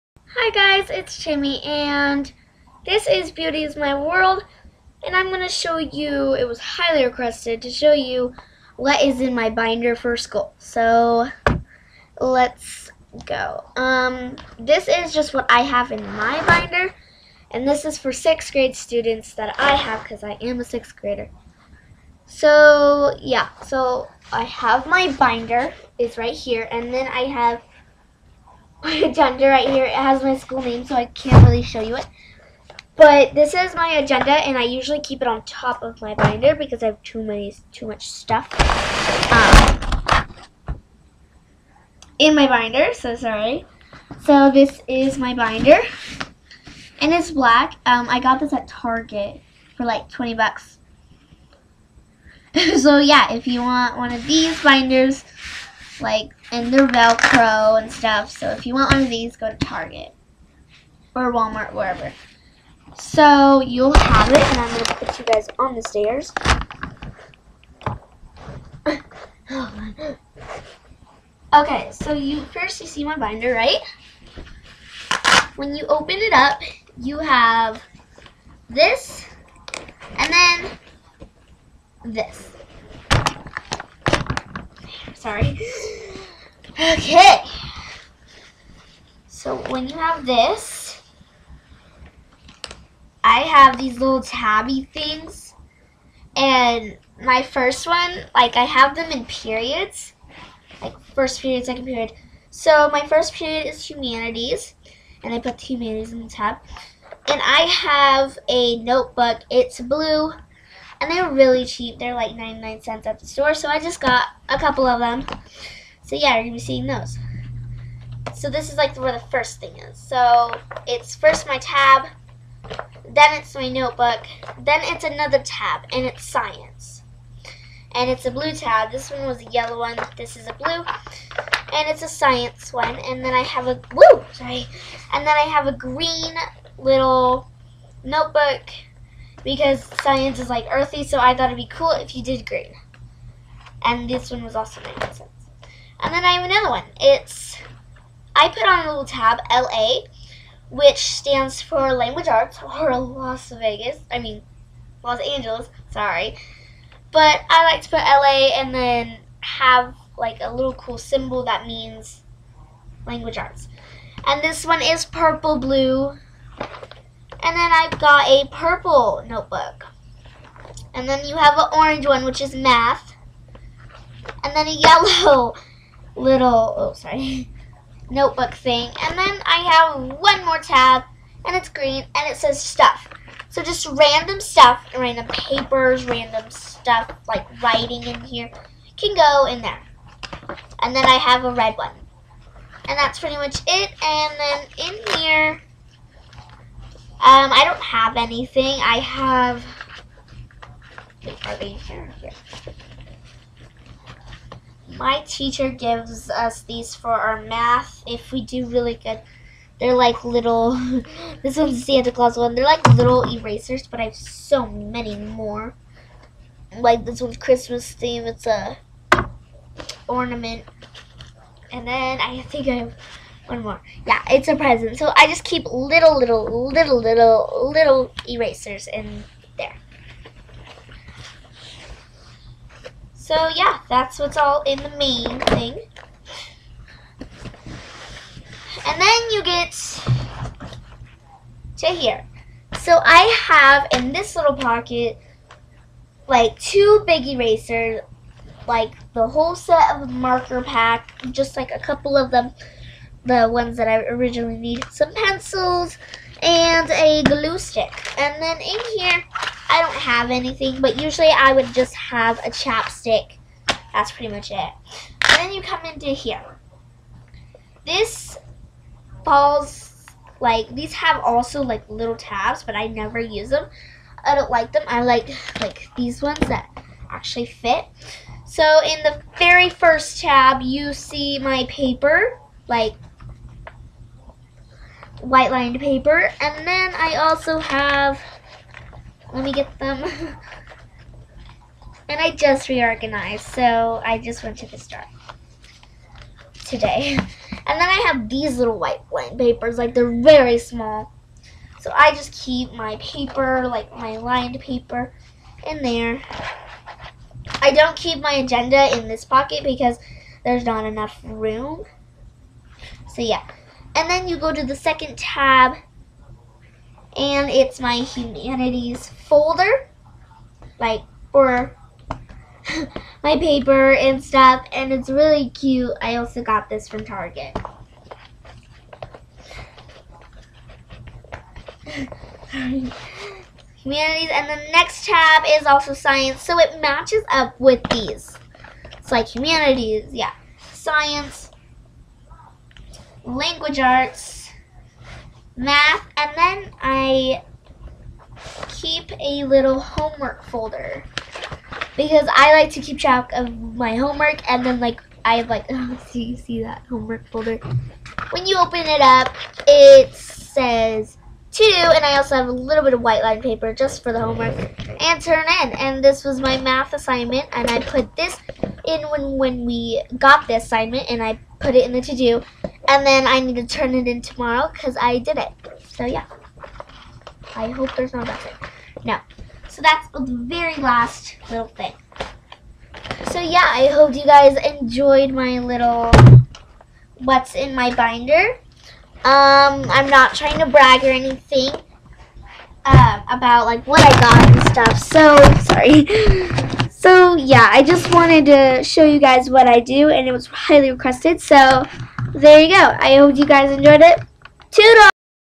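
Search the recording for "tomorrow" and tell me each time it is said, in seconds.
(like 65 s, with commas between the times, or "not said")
374 s.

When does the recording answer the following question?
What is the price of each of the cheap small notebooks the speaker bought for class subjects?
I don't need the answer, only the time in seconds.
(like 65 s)
112 s.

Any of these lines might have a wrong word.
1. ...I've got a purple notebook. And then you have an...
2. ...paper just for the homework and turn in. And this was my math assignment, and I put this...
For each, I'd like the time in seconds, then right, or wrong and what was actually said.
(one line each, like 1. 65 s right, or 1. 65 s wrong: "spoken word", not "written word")
1. 167 s right
2. 363 s right.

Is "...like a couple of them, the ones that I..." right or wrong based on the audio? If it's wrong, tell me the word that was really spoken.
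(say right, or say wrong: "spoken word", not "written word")
right.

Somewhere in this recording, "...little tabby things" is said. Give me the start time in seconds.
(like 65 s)
93 s.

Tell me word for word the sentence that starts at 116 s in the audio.
So yeah, you're gonna be seeing those.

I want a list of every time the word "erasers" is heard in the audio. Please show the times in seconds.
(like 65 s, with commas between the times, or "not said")
213 s, 228 s, 247 s.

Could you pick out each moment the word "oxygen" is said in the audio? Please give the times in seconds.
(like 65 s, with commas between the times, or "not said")
not said.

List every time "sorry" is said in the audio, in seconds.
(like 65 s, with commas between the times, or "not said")
43 s, 85 s, 134 s, 155 s, 176 s, 395 s.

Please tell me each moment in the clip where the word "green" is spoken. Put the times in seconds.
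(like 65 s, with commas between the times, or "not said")
135 s, 142 s, 181 s.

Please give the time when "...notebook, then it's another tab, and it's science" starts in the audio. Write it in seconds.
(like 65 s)
123 s.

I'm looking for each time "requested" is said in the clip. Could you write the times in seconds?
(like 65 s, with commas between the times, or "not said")
7 s, 400 s.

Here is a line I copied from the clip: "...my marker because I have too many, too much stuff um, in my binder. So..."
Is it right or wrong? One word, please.
wrong.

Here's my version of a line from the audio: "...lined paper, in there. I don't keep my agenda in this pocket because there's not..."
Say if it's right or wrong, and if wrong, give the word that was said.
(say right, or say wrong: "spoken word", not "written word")
right.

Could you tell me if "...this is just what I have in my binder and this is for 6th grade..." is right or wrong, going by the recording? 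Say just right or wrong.
right.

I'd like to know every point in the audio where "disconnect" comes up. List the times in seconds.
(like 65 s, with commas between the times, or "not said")
not said.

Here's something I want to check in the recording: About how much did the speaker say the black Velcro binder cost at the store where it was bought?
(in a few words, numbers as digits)
$20.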